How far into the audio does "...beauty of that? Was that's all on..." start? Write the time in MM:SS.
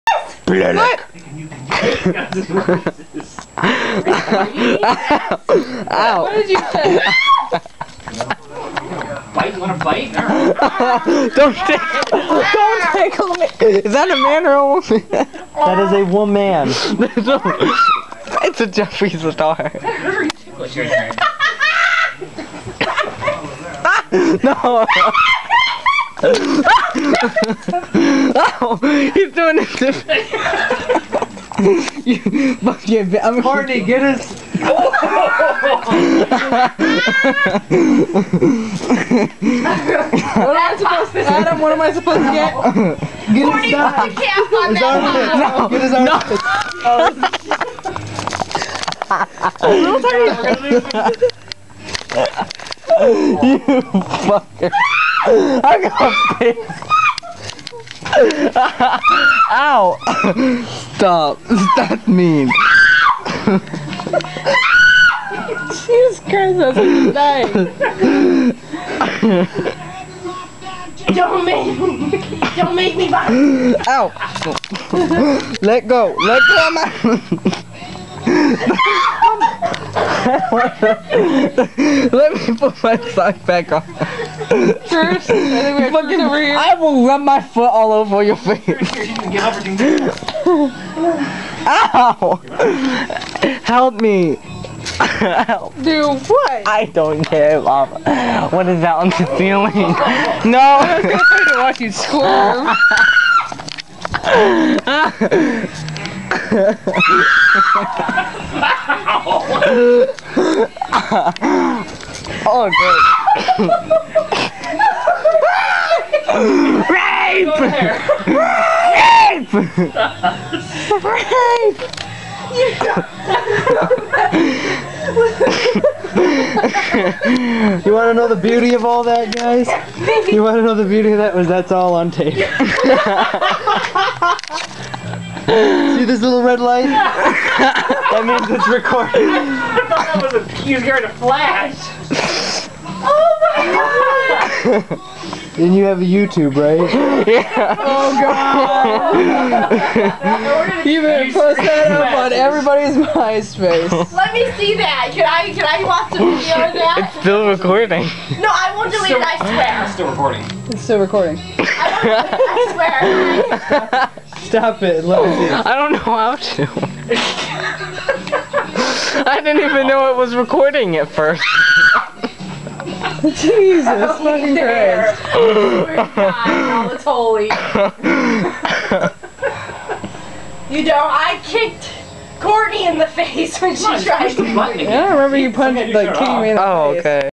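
02:10.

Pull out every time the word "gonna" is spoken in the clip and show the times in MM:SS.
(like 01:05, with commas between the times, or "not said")
00:55, 01:41.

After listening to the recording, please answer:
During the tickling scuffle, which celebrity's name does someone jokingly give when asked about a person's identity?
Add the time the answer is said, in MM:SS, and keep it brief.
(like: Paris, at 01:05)
Jeffree Star, at 00:18.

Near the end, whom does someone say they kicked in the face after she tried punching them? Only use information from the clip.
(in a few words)
Courtney.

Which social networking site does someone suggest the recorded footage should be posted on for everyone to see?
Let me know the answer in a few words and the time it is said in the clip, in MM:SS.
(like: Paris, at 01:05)
MySpace, at 02:32.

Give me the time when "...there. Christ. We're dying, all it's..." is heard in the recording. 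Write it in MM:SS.
02:54.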